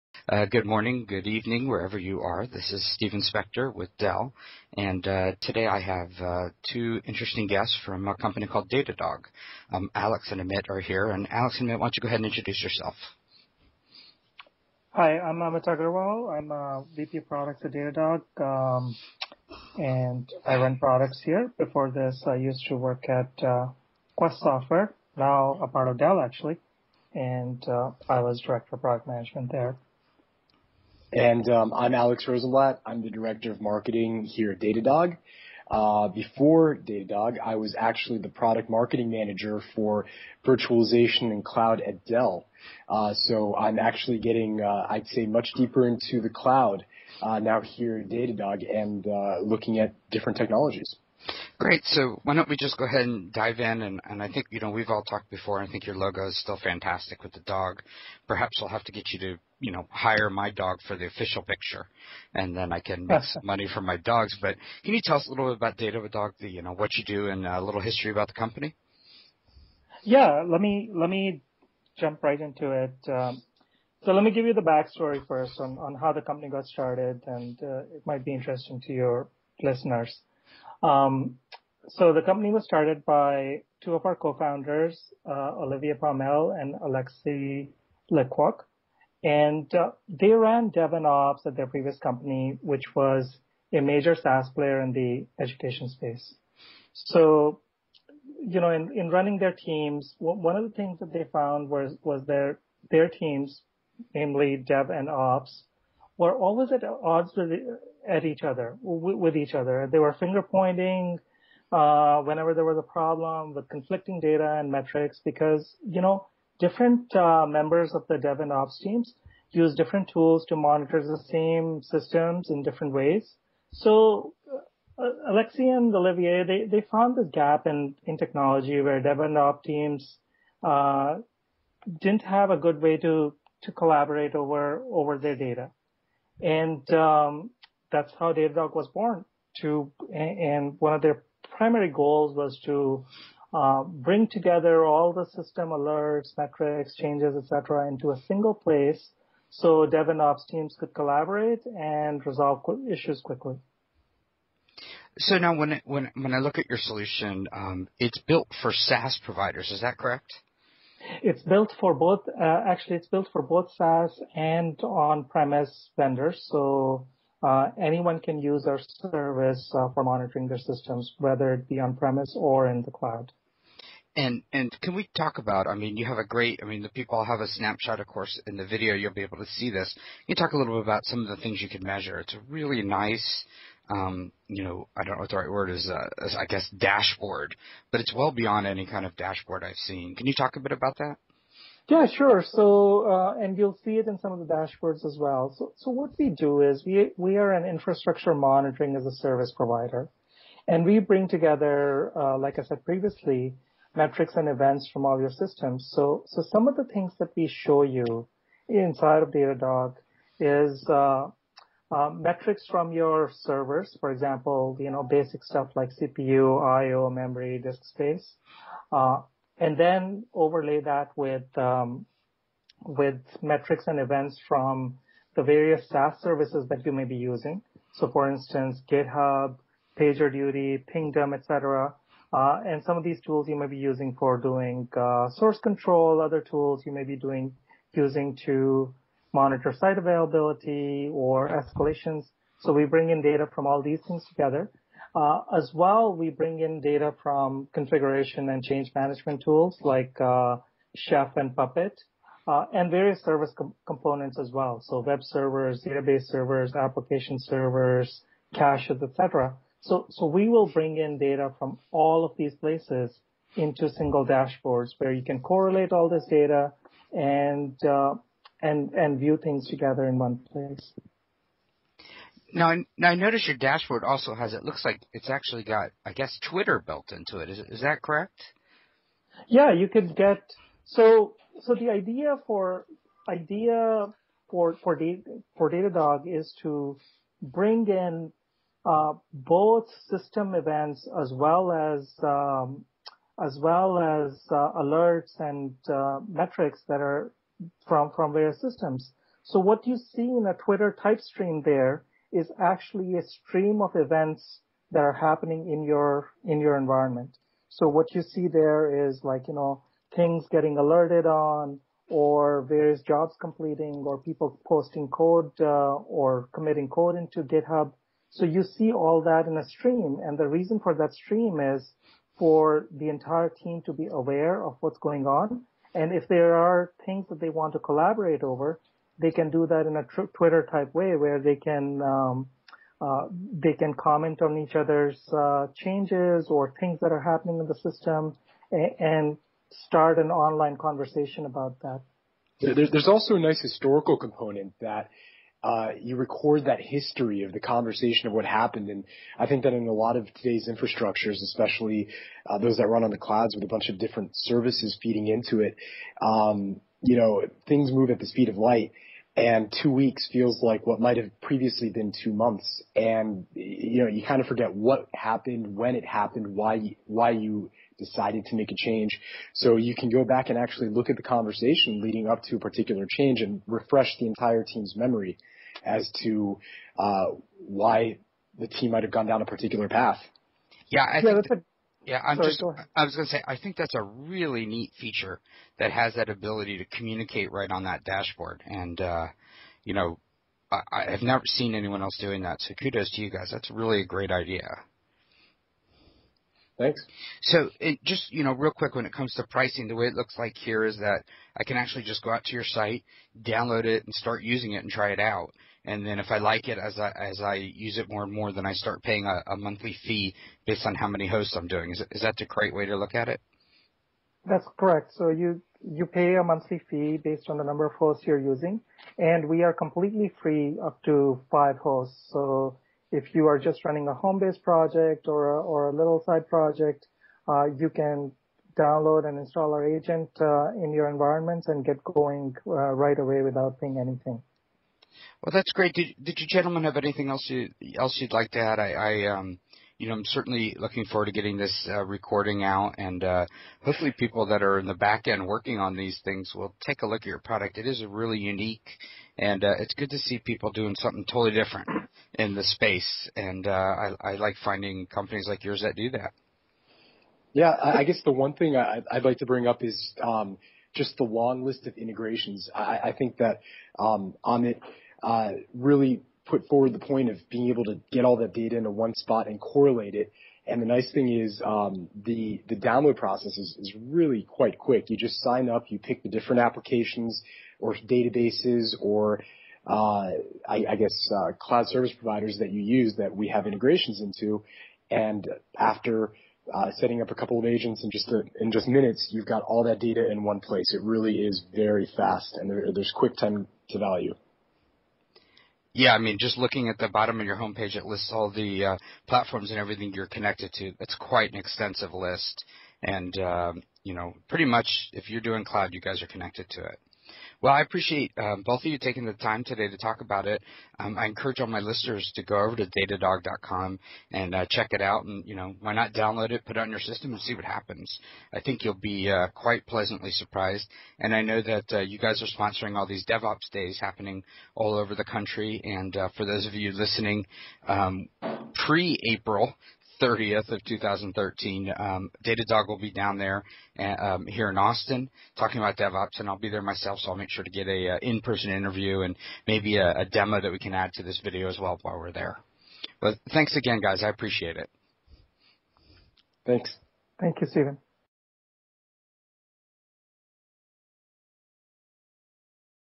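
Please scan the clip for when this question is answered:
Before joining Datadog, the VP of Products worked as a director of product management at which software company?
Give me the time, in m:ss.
0:24.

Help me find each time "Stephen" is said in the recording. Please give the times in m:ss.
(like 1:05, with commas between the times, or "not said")
0:02, 9:07.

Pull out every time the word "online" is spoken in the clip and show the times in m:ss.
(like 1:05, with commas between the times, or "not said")
5:40.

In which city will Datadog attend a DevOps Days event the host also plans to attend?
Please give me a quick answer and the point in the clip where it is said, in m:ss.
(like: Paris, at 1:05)
Austin, at 8:54.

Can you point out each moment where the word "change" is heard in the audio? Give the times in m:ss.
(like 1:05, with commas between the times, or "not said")
2:26, 4:08, 5:35, 6:08, 6:13.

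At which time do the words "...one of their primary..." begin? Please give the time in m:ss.
2:20.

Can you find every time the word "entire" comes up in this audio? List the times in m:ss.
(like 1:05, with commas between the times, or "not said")
5:23, 6:14.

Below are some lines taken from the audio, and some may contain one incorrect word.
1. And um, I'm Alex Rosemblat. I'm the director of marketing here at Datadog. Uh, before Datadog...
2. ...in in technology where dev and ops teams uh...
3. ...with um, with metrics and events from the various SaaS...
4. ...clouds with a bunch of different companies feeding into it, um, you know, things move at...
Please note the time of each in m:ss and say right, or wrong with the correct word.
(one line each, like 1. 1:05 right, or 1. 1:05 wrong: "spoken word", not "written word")
1. 0:31 right
2. 2:07 right
3. 3:41 right
4. 5:53 wrong: "services", not "companies".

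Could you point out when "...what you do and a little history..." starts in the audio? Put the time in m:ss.
1:06.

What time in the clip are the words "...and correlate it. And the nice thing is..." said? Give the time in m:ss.
7:49.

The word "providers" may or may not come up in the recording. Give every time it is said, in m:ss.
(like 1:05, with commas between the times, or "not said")
2:39, 3:19, 8:02.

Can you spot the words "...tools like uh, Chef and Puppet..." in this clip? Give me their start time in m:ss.
4:09.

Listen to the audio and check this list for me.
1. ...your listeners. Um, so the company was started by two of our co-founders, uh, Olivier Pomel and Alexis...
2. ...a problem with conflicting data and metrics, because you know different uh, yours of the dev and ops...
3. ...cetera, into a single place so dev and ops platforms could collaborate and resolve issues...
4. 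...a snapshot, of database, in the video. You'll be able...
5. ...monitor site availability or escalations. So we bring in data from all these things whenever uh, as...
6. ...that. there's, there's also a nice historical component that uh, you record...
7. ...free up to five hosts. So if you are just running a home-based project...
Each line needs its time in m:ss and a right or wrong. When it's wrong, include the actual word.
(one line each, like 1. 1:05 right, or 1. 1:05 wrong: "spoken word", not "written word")
1. 1:18 right
2. 1:52 wrong: "members", not "yours"
3. 2:27 wrong: "teams", not "platforms"
4. 2:57 wrong: "course", not "database"
5. 3:59 wrong: "together", not "whenever"
6. 5:41 right
7. 7:00 right.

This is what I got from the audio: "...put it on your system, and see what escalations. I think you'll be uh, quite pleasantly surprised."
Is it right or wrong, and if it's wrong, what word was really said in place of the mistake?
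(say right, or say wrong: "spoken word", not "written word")
wrong: "happens", not "escalations".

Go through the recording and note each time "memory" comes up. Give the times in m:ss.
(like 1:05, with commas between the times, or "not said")
3:37, 6:14.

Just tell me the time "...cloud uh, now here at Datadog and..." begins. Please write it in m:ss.
0:46.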